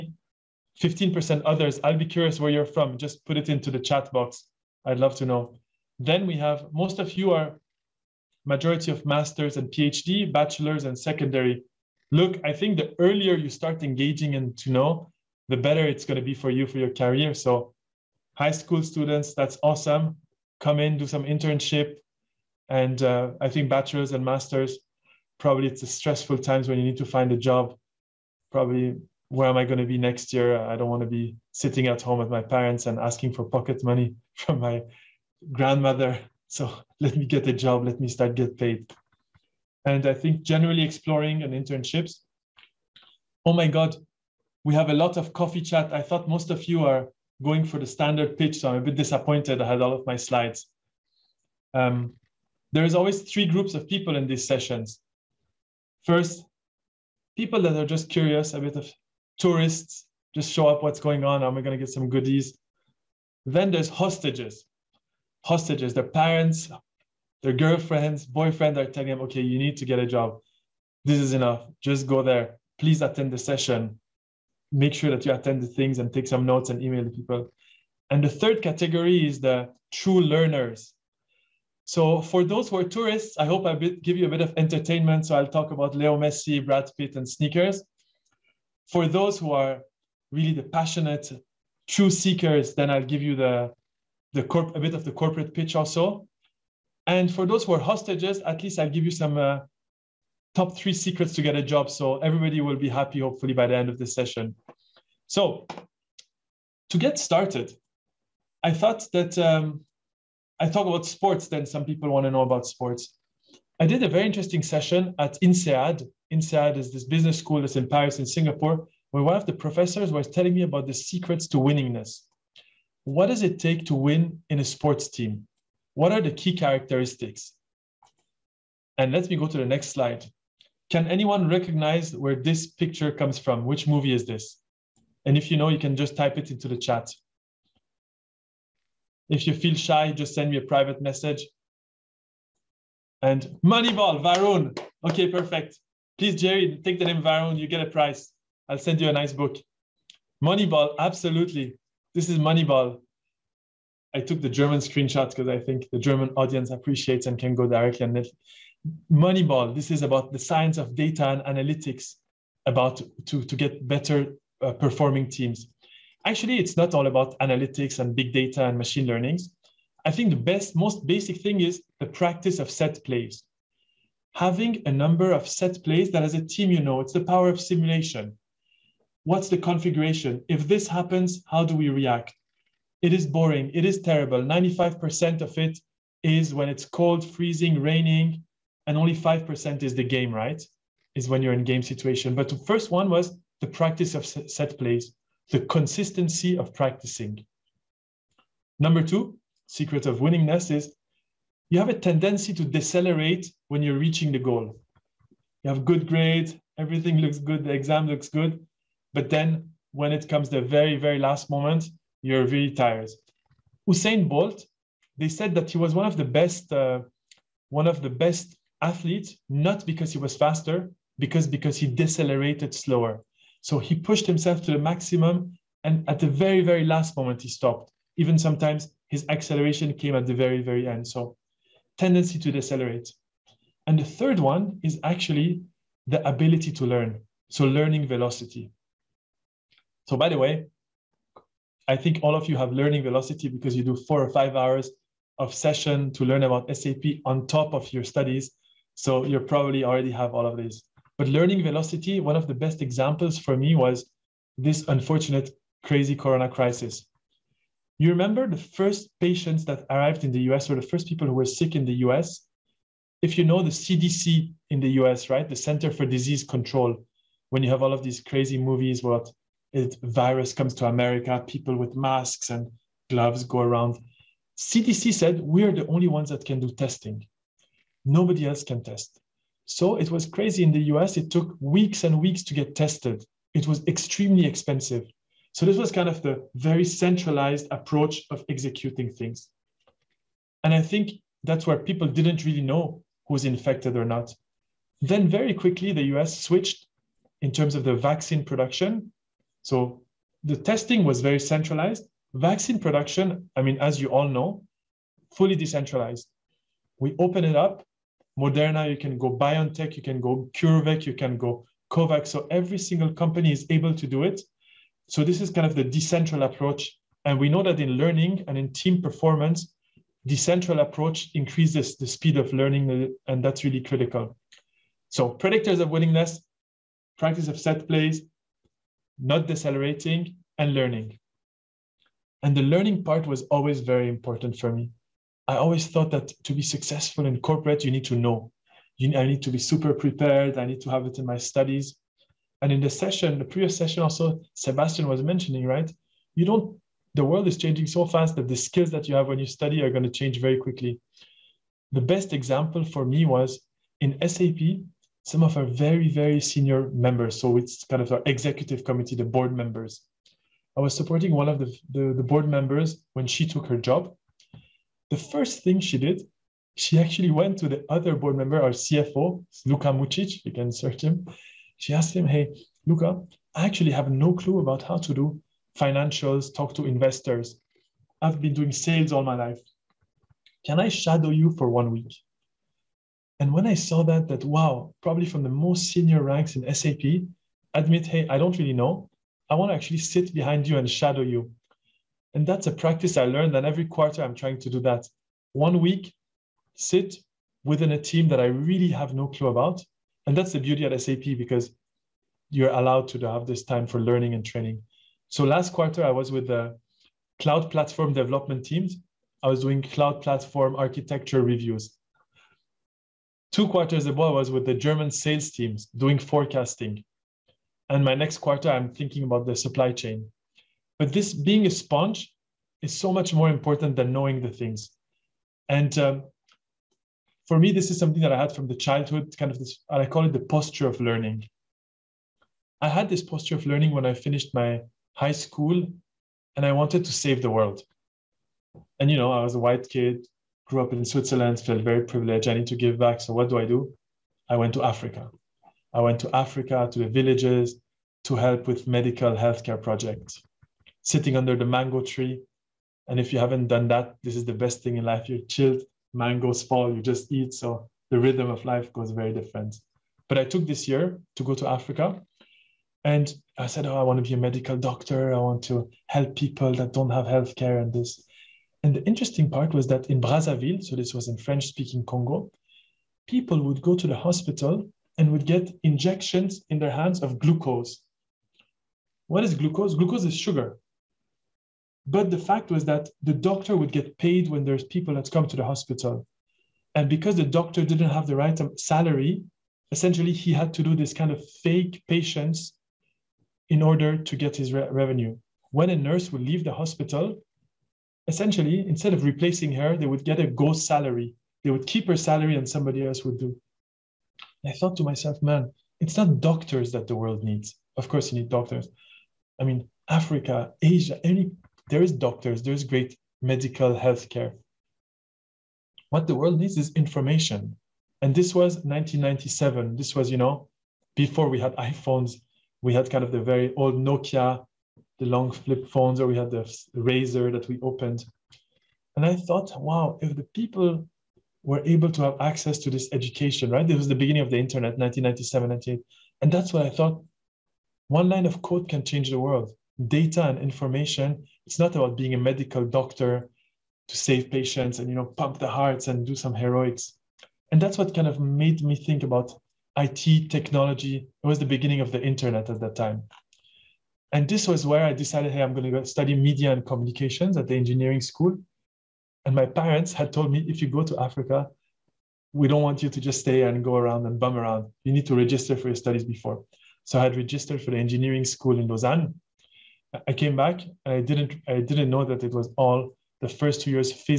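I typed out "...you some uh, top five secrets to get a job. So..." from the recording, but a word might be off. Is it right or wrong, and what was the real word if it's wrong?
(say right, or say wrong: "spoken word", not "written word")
wrong: "three", not "five".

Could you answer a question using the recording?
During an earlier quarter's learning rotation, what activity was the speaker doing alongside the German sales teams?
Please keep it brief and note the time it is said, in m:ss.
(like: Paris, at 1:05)
forecasting, at 6:56.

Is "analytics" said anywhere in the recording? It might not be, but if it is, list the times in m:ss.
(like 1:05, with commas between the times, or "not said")
2:41, 2:47.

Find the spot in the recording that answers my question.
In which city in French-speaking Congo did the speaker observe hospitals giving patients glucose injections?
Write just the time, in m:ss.
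7:50.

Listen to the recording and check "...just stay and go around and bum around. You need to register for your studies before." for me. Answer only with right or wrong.
right.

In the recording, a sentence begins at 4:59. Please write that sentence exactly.
So the testing was very centralized.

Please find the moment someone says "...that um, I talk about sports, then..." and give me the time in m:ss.
1:49.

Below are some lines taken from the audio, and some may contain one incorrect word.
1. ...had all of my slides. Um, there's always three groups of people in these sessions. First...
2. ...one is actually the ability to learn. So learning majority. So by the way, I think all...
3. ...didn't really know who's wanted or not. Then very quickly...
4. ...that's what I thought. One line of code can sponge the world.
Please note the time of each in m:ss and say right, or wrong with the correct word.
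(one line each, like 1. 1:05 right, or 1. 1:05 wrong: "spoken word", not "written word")
1. 0:49 right
2. 3:54 wrong: "velocity", not "majority"
3. 4:52 wrong: "infected", not "wanted"
4. 8:56 wrong: "change", not "sponge".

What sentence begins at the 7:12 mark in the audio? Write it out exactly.
I had this posture of learning when I finished my high school and I wanted to save the world.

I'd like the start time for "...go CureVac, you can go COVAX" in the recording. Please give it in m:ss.
5:10.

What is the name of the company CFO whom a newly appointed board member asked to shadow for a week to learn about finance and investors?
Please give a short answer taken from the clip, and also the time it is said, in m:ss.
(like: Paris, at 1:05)
Luka Mucic, at 6:09.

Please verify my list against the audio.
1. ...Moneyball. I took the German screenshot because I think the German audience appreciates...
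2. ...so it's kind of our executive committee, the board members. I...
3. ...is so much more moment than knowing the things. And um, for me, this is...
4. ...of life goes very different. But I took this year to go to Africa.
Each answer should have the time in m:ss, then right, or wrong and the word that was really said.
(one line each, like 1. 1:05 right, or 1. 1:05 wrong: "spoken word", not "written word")
1. 2:32 right
2. 5:57 right
3. 7:02 wrong: "important", not "moment"
4. 7:38 right.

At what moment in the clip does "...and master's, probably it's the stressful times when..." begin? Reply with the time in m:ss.
0:24.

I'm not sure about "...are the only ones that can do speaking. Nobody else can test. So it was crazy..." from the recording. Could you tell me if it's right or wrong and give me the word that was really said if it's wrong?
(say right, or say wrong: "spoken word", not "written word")
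wrong: "testing", not "speaking".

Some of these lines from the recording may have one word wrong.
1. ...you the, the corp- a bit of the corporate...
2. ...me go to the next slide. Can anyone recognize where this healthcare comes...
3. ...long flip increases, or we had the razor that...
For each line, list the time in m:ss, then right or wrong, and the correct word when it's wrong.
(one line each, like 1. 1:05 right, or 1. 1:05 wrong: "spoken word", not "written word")
1. 1:33 right
2. 2:09 wrong: "picture", not "healthcare"
3. 8:45 wrong: "phones", not "increases".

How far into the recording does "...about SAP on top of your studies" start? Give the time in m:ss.
4:06.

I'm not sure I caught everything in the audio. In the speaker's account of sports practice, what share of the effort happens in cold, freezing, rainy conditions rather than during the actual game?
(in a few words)
95%.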